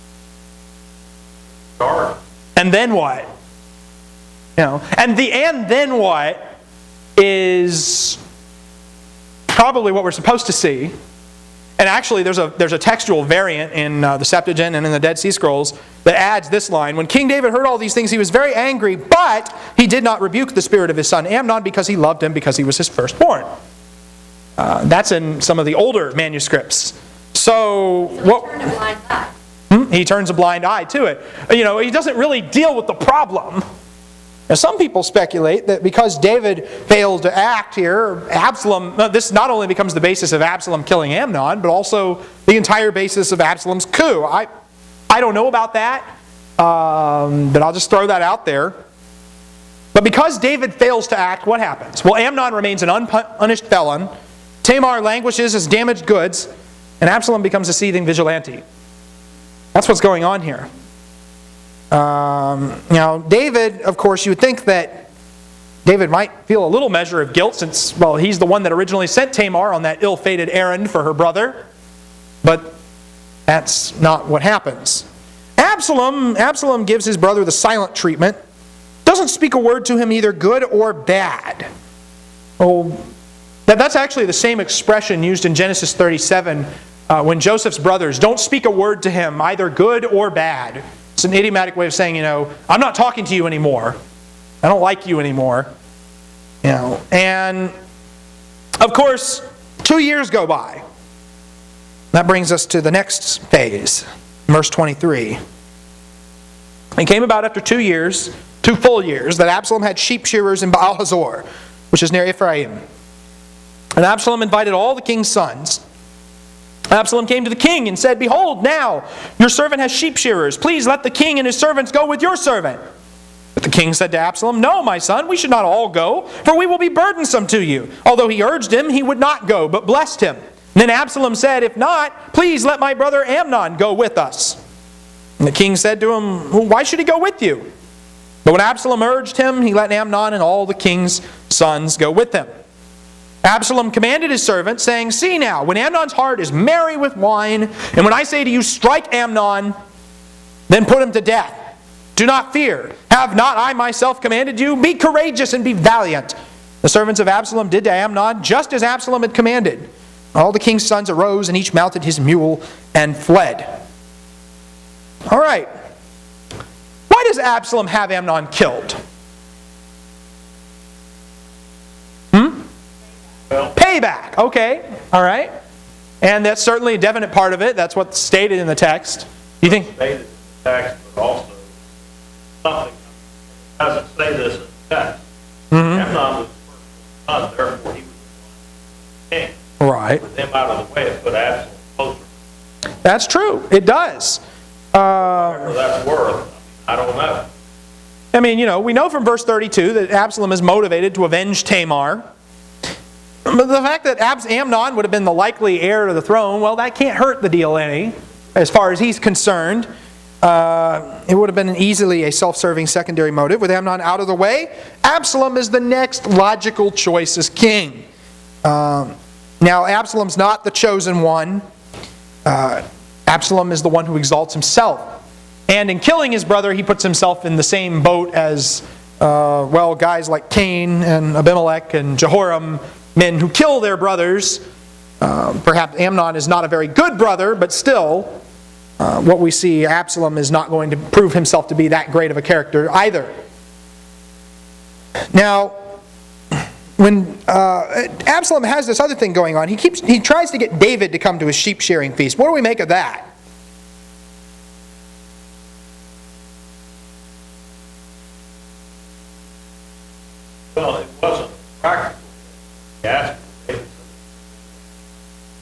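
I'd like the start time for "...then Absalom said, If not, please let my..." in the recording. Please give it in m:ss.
2:10.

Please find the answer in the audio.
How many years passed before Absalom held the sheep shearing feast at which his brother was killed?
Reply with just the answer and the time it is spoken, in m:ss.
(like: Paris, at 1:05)
2, at 1:48.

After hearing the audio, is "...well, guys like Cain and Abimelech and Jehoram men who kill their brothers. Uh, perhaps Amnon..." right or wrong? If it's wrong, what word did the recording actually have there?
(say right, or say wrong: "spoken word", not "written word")
right.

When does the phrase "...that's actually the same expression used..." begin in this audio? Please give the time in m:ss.
1:23.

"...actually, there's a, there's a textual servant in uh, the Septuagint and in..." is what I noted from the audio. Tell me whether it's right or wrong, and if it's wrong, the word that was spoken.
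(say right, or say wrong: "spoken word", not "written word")
wrong: "variant", not "servant".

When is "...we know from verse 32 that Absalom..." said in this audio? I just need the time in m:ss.
3:18.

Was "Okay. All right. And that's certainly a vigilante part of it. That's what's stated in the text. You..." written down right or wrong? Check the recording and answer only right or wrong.
wrong.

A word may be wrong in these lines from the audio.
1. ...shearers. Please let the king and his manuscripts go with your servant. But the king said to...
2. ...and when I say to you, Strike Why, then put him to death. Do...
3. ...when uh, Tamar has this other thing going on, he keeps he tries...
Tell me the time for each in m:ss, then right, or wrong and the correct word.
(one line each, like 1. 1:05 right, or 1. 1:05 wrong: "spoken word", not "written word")
1. 2:00 wrong: "servants", not "manuscripts"
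2. 2:27 wrong: "Amnon", not "Why"
3. 4:06 wrong: "Absalom", not "Tamar".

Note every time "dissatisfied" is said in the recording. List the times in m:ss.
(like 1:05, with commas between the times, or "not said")
not said.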